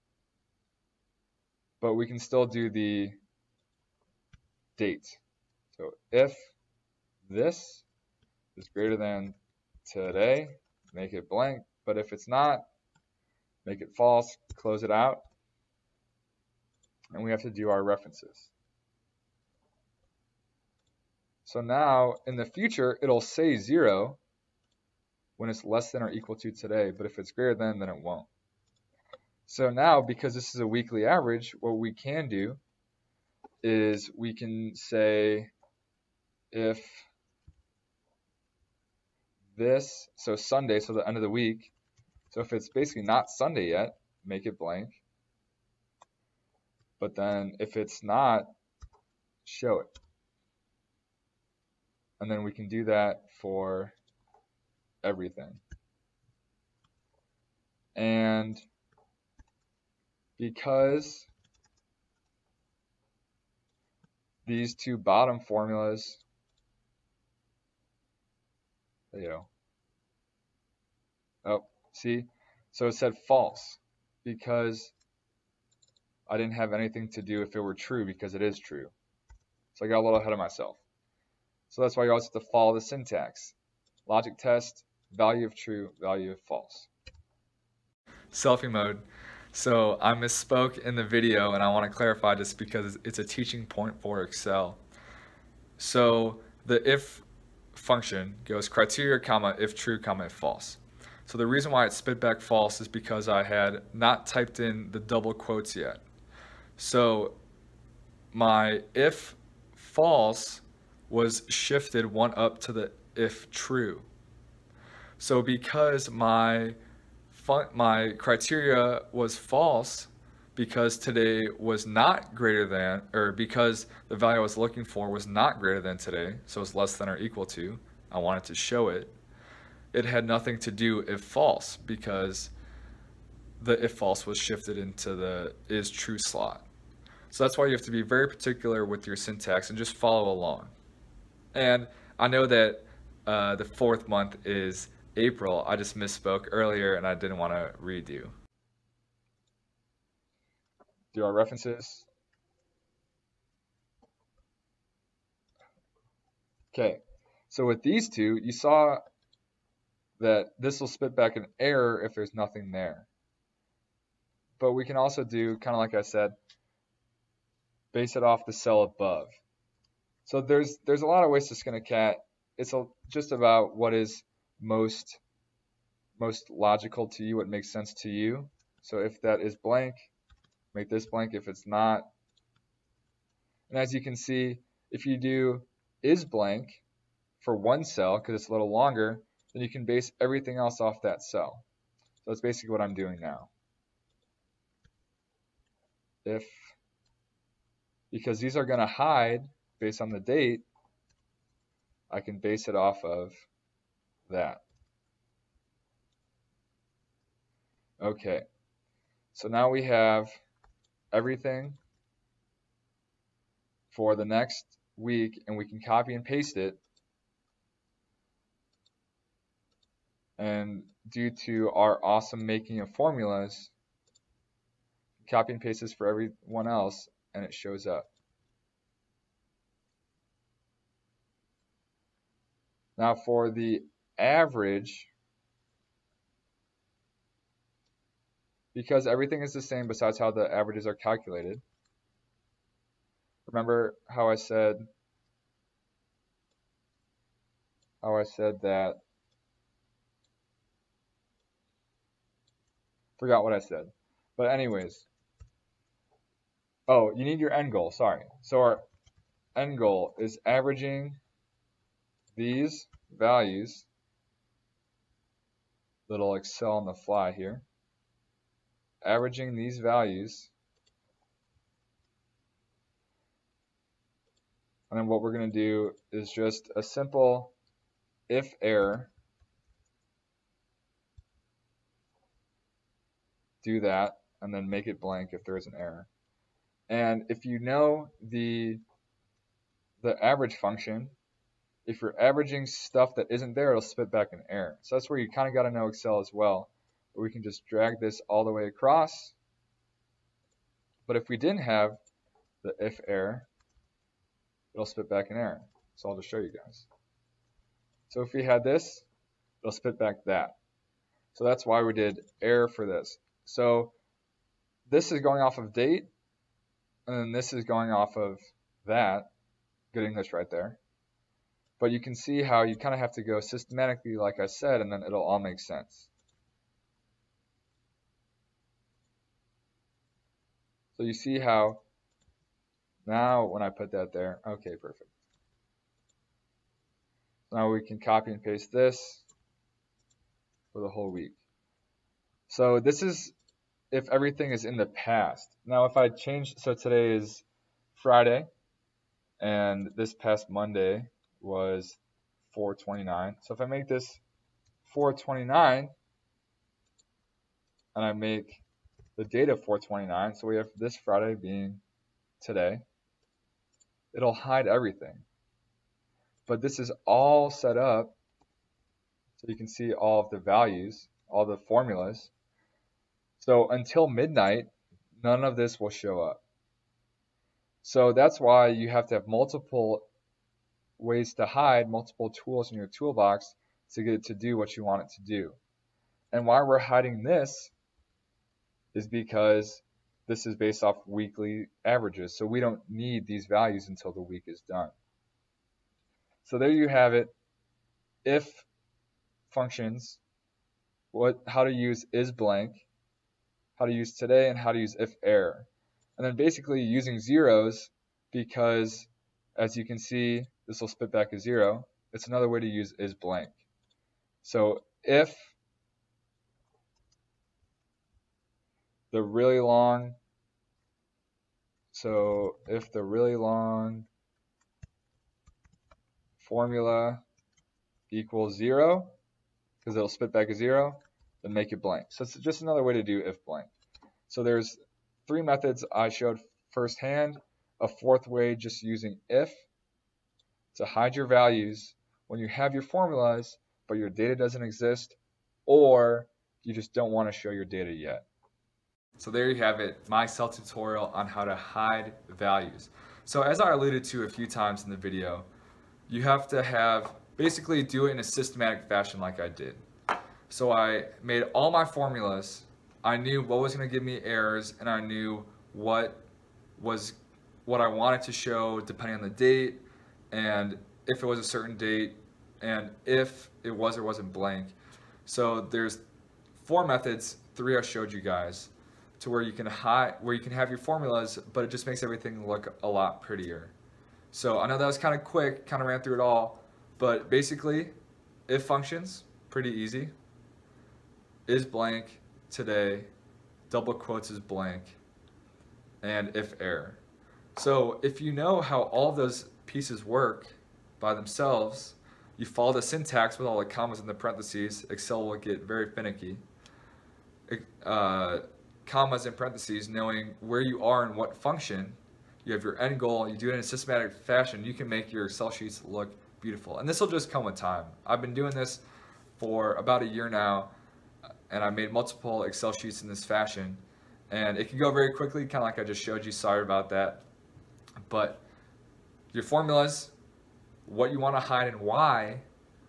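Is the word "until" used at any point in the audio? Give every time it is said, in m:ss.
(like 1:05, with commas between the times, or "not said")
6:13, 6:33.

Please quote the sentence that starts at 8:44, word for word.
And it can go very quickly, kind of like I just showed you, sorry about that.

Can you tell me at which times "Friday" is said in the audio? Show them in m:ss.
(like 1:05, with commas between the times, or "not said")
5:48, 6:00.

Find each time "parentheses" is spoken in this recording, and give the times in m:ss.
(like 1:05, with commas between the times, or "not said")
8:24, 8:29.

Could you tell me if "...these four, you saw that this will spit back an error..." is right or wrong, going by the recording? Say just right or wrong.
wrong.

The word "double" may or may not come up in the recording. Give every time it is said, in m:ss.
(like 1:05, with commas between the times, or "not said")
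1:44, 8:13.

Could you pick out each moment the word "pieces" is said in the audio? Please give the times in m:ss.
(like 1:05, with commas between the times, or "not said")
8:19.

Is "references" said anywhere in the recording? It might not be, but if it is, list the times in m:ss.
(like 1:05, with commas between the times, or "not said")
0:17, 2:31.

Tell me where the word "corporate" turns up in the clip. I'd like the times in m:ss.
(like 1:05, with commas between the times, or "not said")
not said.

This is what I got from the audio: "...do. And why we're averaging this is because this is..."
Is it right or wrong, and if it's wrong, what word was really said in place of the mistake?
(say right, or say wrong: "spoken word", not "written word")
wrong: "hiding", not "averaging".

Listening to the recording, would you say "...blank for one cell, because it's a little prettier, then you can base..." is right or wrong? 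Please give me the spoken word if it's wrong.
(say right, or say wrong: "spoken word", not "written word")
wrong: "longer", not "prettier".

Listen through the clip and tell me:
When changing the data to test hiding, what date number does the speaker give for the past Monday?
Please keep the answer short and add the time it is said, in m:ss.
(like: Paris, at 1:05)
429, at 5:49.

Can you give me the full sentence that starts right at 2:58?
So if that is blank, make this blank.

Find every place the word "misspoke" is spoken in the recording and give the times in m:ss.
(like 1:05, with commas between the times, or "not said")
1:30, 2:25.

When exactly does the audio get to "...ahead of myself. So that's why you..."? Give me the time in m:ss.
1:20.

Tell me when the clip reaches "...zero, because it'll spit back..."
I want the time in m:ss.
7:08.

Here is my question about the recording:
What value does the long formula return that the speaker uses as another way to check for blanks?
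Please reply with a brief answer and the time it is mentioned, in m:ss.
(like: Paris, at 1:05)
0, at 6:50.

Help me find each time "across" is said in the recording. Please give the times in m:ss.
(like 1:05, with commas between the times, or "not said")
4:58.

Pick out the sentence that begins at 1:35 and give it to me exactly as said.
So the if function goes criteria comma if true comma if false.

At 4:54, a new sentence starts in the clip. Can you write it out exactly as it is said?
So that's where you kind of got to know Excel as well.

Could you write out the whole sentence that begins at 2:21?
And I know that uh, the fourth month is April.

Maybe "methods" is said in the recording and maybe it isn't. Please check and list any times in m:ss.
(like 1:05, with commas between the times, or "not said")
7:15, 7:56.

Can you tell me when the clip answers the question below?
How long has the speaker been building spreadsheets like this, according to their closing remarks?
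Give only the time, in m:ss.
8:39.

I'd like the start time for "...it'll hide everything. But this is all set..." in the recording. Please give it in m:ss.
6:04.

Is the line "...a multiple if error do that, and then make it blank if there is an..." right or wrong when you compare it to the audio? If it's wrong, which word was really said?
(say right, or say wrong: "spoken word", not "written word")
wrong: "simple", not "multiple".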